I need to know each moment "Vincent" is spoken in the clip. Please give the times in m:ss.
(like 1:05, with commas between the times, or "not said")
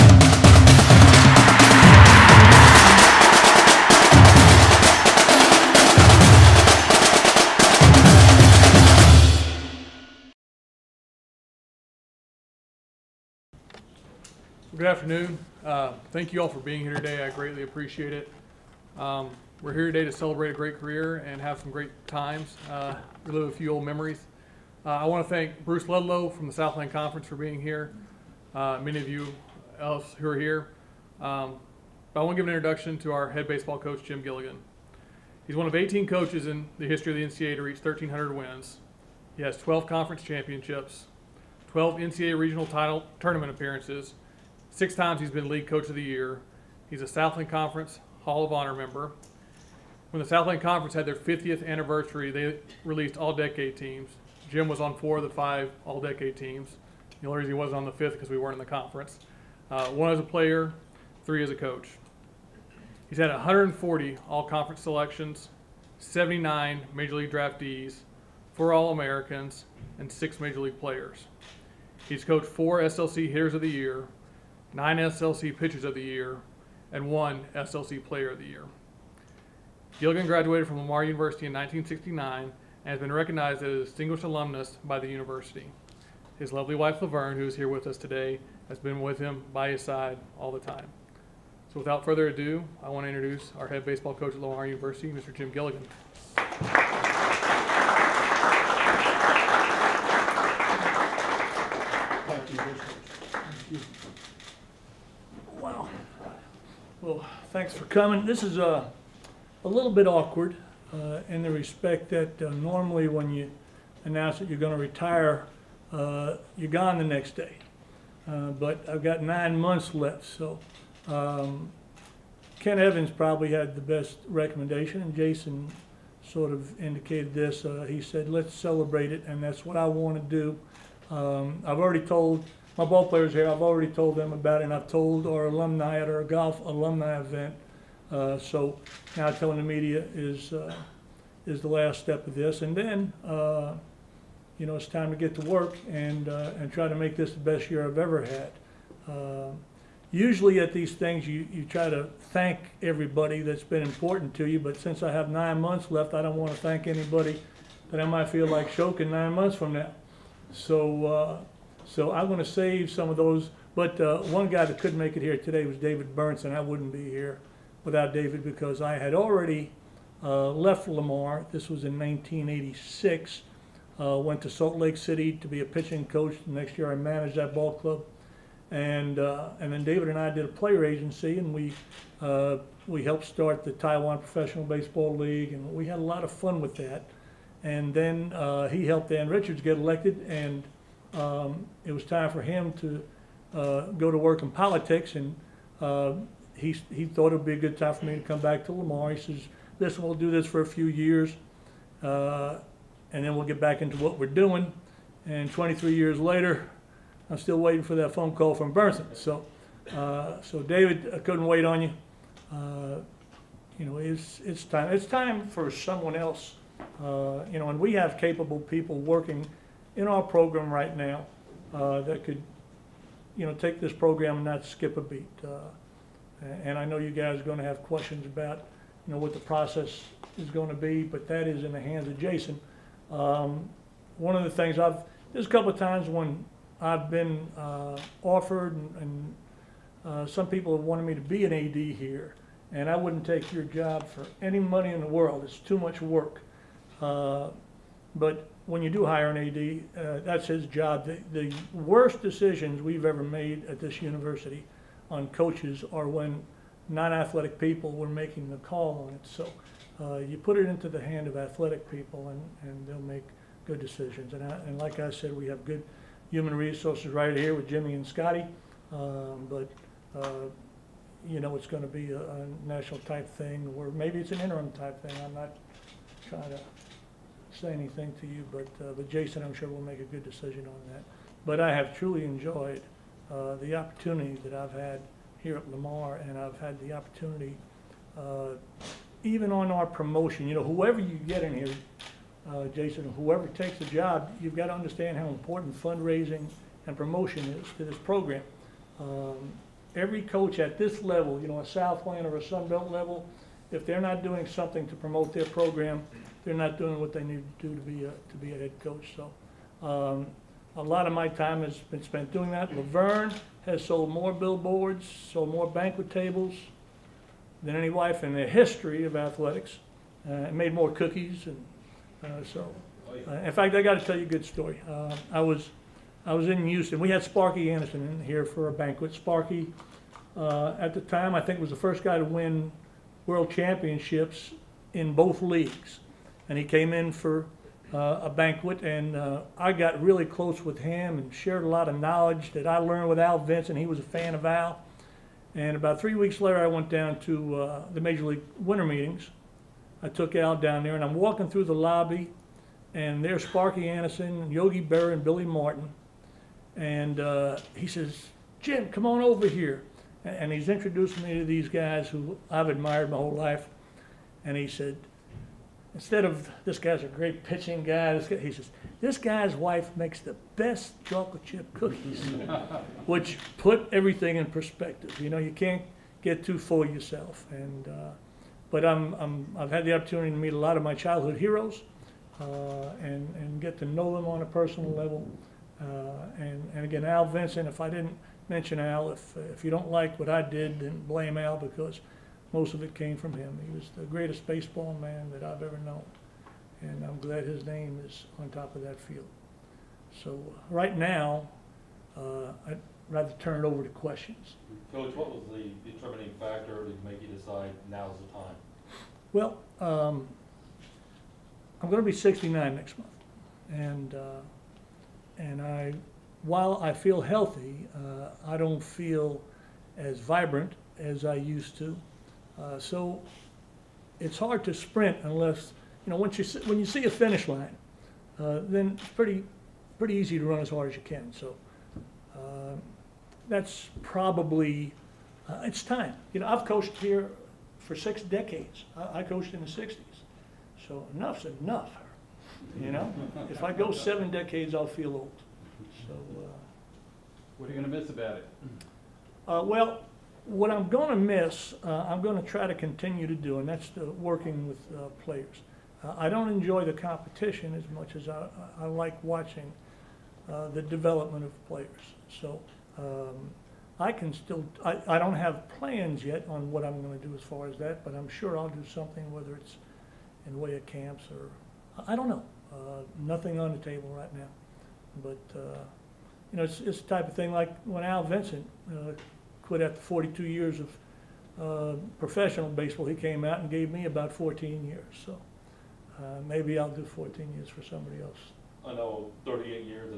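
5:43, 6:27, 7:58.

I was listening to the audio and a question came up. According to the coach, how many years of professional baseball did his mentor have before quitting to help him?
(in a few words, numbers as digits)
42.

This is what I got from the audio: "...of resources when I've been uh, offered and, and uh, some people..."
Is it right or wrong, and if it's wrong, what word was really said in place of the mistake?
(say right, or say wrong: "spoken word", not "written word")
wrong: "times", not "resources".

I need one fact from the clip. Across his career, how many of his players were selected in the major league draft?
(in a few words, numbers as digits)
79.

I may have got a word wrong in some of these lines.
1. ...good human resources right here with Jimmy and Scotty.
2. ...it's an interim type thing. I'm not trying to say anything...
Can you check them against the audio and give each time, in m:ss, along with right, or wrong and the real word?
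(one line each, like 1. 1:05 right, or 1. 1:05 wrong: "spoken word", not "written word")
1. 4:25 right
2. 4:34 right.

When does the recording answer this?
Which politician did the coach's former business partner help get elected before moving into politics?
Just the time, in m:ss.
3:09.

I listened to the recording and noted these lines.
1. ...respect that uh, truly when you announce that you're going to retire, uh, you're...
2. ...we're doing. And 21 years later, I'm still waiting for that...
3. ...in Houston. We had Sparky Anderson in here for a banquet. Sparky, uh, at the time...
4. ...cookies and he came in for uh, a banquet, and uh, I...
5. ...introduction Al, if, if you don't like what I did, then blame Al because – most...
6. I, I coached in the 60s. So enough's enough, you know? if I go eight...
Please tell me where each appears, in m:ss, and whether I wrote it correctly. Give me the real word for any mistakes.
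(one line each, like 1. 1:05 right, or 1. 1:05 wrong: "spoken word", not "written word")
1. 1:51 wrong: "normally", not "truly"
2. 3:24 wrong: "23", not "21"
3. 5:26 right
4. 5:35 wrong: "leagues", not "cookies"
5. 6:28 wrong: "mention", not "introduction"
6. 7:18 wrong: "seven", not "eight".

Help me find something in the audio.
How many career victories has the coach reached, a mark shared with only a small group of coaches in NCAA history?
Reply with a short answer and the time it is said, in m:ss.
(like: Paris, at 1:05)
1,300, at 0:37.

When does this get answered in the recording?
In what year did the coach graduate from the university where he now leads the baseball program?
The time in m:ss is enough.
1:21.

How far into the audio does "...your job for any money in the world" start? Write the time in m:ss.
4:03.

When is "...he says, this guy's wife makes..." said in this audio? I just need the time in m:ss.
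6:08.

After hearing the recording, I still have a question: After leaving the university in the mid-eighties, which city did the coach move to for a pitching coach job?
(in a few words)
Salt Lake City.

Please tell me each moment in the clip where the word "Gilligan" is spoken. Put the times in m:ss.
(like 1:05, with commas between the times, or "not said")
0:34, 1:19, 1:35.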